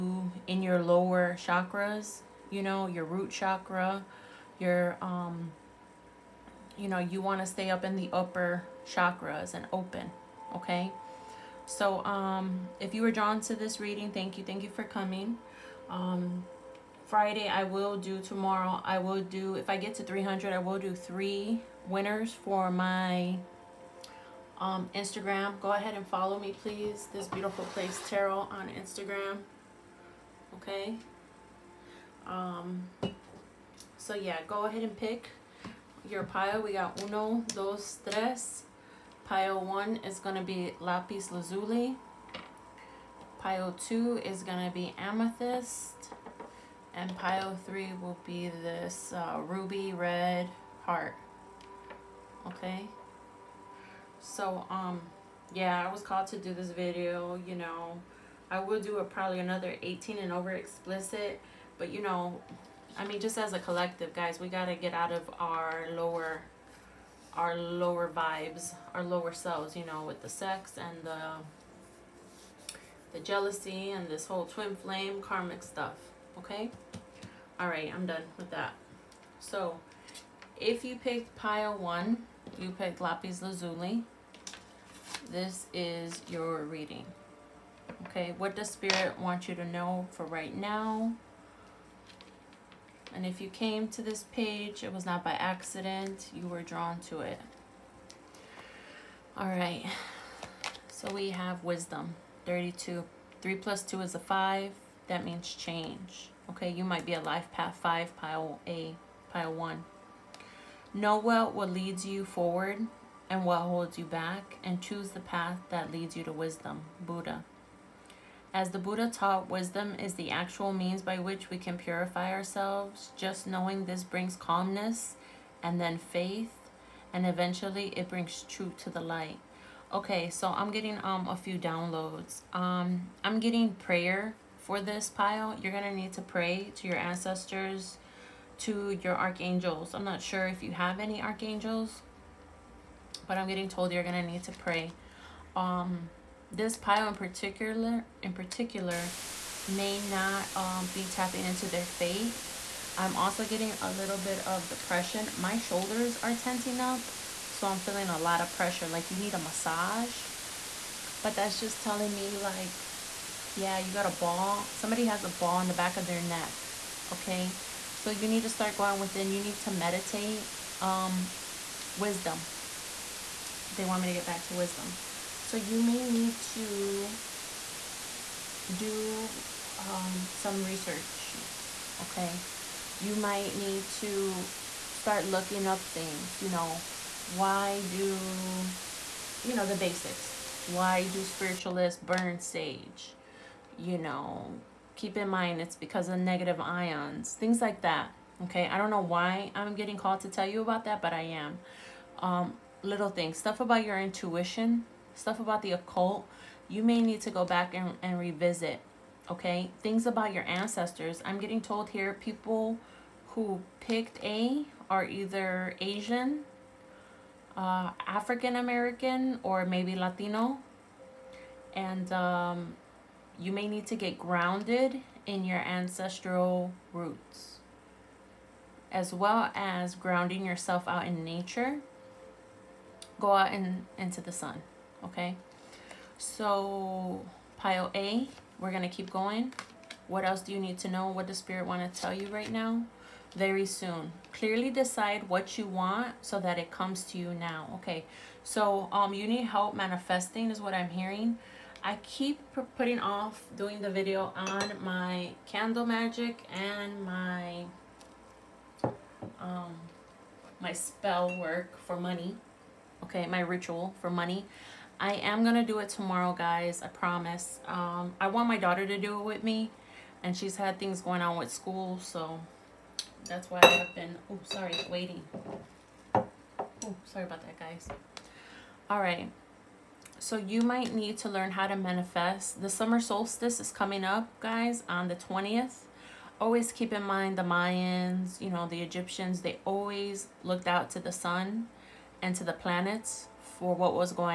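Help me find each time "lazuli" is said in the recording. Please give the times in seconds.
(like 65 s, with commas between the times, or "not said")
41 s, 83 s.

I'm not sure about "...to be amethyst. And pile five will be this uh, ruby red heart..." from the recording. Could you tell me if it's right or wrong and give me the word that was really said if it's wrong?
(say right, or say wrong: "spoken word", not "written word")
wrong: "three", not "five".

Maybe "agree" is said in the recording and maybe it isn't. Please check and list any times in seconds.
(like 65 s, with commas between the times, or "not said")
not said.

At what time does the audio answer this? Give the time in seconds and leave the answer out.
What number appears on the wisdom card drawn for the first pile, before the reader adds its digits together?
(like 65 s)
102 s.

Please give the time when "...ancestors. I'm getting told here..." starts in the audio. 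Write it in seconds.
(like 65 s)
210 s.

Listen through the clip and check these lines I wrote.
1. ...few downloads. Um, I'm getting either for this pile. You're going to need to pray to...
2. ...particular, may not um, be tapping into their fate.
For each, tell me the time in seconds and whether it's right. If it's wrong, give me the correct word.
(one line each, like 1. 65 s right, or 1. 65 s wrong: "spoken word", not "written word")
1. 131 s wrong: "prayer", not "either"
2. 148 s right.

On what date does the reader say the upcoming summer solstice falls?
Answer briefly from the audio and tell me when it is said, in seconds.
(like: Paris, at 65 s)
20th, at 285 s.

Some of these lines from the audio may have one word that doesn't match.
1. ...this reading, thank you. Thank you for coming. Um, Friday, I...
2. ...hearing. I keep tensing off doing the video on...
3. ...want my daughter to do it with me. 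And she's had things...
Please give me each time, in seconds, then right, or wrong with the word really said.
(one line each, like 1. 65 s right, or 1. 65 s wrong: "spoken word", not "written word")
1. 13 s right
2. 250 s wrong: "putting", not "tensing"
3. 268 s right.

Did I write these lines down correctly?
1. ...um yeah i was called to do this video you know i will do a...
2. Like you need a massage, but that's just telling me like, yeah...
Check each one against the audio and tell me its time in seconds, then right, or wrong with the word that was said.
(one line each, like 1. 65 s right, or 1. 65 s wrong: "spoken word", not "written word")
1. 54 s right
2. 158 s right.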